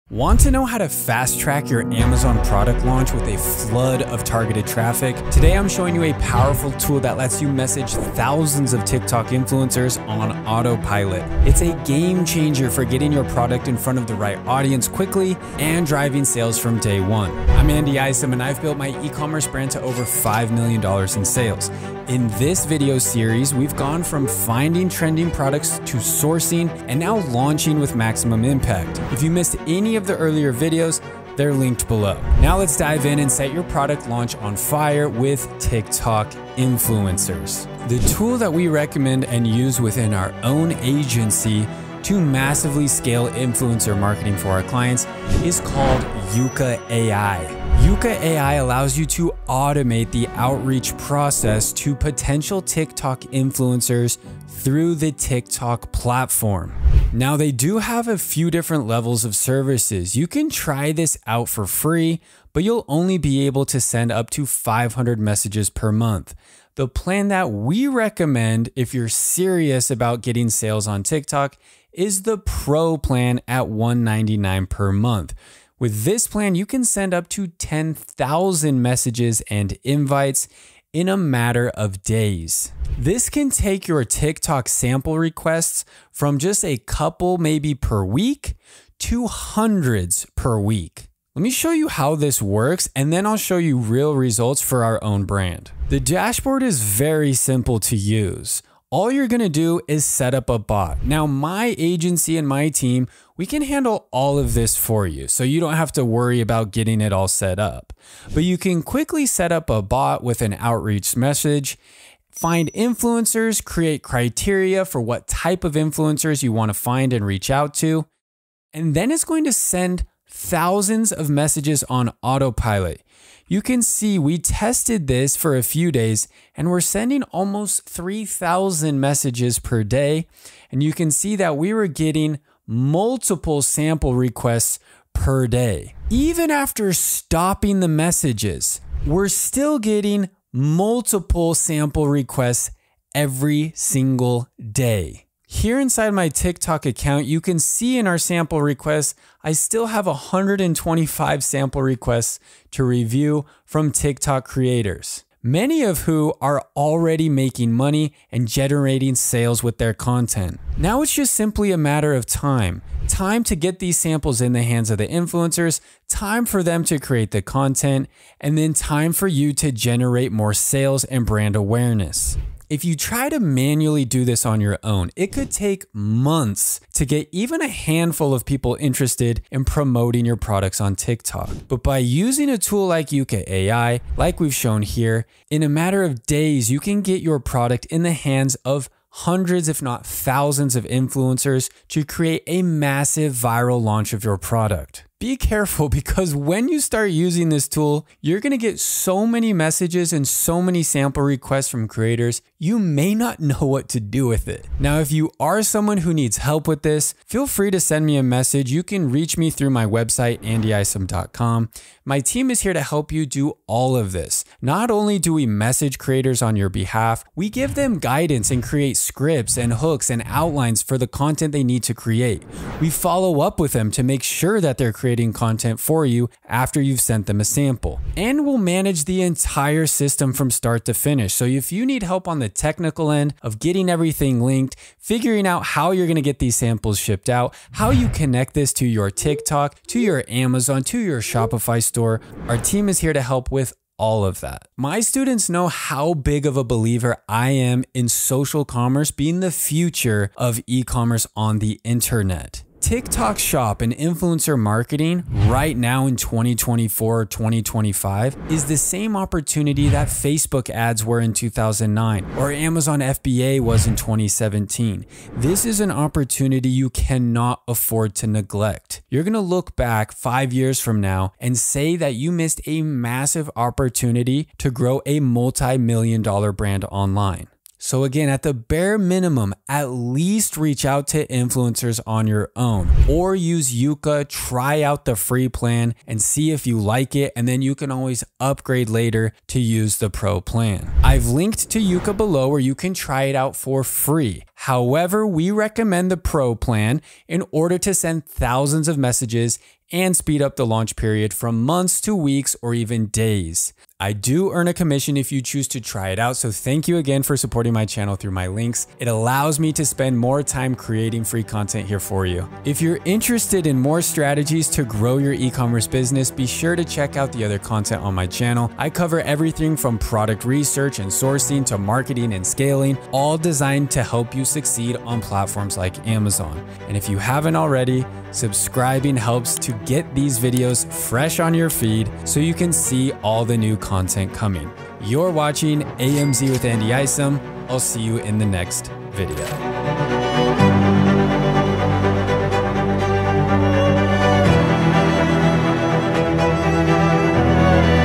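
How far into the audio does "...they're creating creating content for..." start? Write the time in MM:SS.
03:44.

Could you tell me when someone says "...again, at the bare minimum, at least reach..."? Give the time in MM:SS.
04:38.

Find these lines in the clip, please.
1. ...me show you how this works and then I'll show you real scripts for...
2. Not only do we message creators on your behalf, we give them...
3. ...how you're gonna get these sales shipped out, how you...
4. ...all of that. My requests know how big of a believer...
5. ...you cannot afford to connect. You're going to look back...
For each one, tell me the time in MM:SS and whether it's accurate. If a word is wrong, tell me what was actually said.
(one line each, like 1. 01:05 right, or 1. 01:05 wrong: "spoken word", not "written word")
1. 01:31 wrong: "results", not "scripts"
2. 03:34 right
3. 03:55 wrong: "samples", not "sales"
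4. 04:03 wrong: "students", not "requests"
5. 04:26 wrong: "neglect", not "connect".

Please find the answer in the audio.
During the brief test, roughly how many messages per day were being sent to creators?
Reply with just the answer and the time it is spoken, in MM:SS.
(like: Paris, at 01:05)
3,000, at 02:07.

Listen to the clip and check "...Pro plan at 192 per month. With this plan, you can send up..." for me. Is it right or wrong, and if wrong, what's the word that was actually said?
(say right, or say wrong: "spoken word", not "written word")
wrong: "199", not "192".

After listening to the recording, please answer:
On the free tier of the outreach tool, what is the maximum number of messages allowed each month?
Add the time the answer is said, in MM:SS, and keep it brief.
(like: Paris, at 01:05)
500, at 01:04.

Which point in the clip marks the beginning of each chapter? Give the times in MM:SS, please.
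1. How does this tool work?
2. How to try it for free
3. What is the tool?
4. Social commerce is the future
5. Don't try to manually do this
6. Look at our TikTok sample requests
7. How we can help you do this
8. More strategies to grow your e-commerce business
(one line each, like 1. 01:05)
1. 01:31
2. 04:50
3. 00:38
4. 04:05
5. 02:52
6. 02:25
7. 03:24
8. 05:12.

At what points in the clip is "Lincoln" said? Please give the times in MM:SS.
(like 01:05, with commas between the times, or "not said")
not said.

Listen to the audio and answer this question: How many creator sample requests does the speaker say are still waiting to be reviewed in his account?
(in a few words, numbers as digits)
125.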